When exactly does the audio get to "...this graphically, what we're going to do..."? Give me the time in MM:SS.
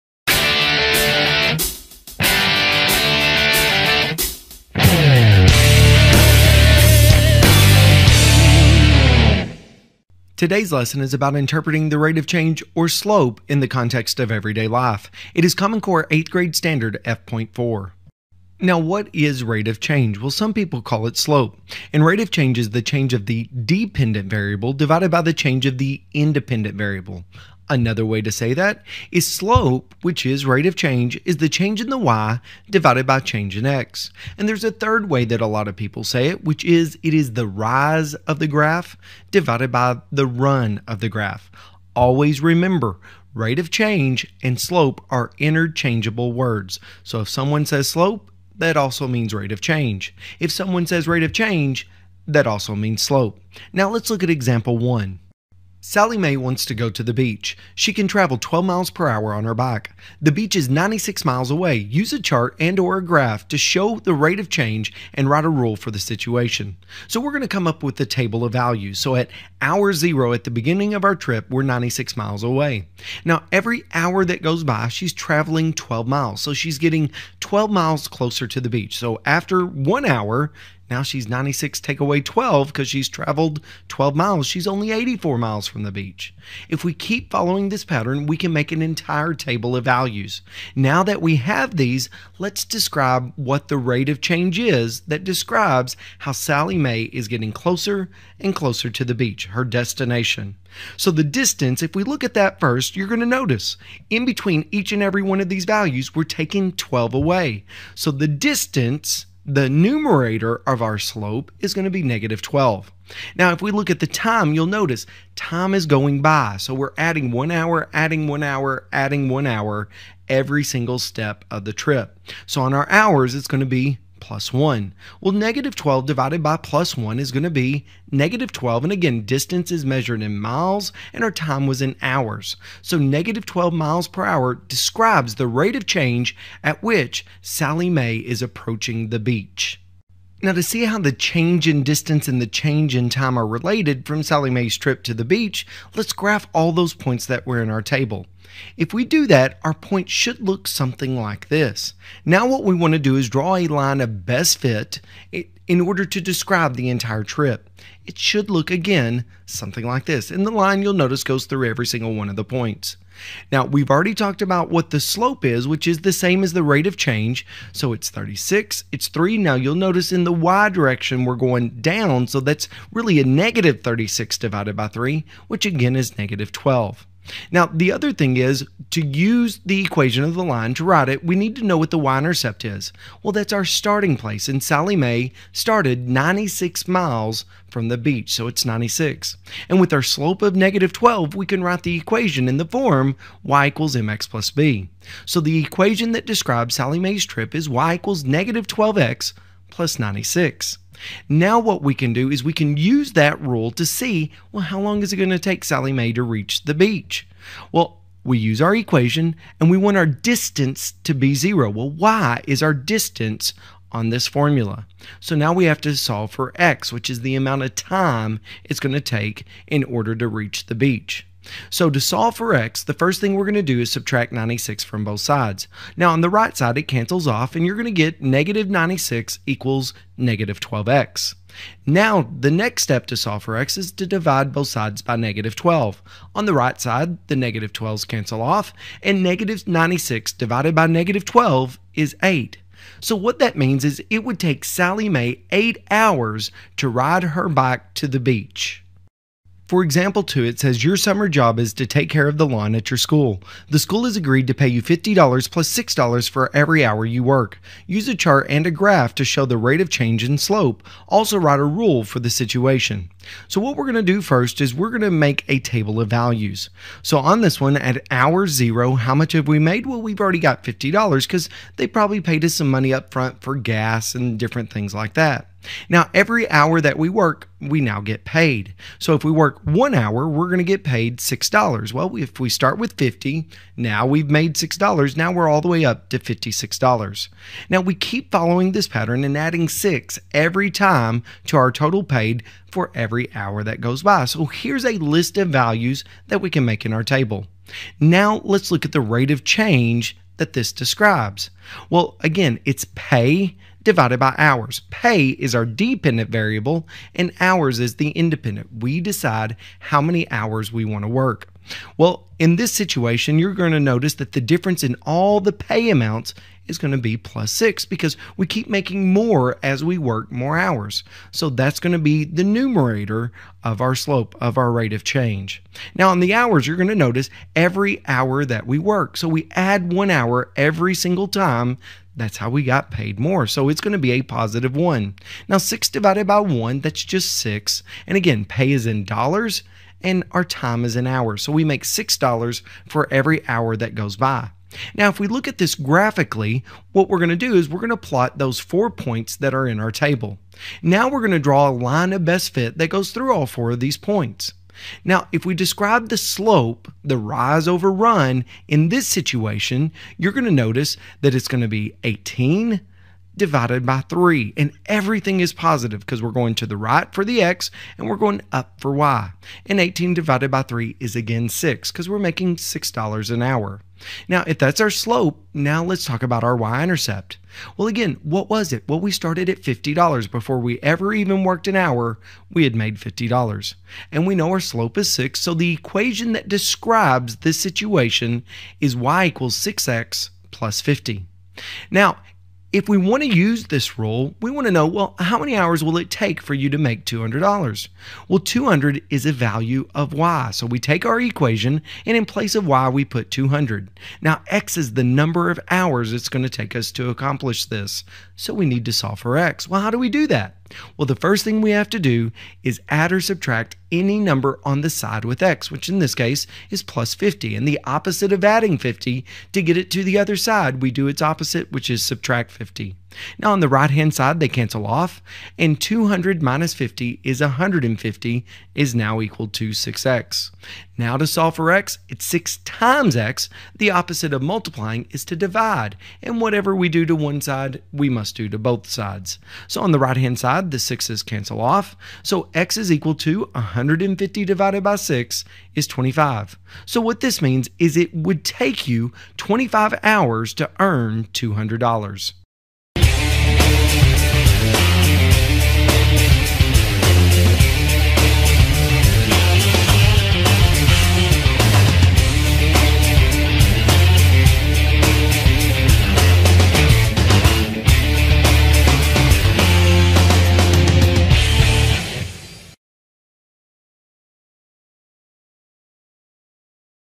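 05:45.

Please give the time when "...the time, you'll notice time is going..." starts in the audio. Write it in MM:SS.
01:53.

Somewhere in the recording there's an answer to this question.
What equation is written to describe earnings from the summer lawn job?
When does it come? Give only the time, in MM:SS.
06:28.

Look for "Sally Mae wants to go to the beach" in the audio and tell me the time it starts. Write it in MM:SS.
00:55.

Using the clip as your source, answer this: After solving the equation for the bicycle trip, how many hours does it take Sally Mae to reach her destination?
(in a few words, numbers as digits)
8 hours.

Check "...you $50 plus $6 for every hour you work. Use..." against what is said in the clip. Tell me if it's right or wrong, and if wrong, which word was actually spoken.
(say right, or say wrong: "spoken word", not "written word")
right.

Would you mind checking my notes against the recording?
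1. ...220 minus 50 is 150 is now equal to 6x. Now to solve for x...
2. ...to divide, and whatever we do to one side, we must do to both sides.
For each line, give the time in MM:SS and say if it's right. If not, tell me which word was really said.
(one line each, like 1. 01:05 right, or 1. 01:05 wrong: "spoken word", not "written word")
1. 07:05 wrong: "200", not "220"
2. 07:15 right.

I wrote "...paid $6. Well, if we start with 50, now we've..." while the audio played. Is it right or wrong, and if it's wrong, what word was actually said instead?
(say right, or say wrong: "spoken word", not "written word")
right.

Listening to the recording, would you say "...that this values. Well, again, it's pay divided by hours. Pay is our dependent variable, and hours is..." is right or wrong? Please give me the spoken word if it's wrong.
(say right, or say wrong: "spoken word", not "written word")
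wrong: "describes", not "values".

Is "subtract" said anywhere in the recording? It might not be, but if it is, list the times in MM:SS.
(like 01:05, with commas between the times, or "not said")
03:43, 06:53, 07:02.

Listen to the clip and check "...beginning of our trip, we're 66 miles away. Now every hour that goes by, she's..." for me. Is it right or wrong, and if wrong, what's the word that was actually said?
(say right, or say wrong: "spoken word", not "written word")
wrong: "96", not "66".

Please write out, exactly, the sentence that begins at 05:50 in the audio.
Now we're going to draw a line of best fit that goes through all four of these points.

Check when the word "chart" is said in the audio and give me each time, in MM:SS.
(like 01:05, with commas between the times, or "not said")
01:02, 04:18.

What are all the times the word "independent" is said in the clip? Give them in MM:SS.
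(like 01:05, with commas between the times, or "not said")
00:26, 05:08.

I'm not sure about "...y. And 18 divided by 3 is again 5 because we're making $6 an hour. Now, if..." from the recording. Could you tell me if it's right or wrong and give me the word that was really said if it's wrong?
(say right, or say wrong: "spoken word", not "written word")
wrong: "6", not "5".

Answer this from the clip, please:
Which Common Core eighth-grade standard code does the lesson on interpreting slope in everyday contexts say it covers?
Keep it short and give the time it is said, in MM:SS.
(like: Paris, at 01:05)
F.4, at 00:17.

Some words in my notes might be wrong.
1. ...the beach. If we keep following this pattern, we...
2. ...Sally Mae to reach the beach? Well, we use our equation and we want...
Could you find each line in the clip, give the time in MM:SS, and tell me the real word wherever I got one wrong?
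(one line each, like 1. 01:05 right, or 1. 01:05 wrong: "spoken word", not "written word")
1. 01:25 right
2. 03:25 right.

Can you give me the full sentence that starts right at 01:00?
The beach is 96 miles away.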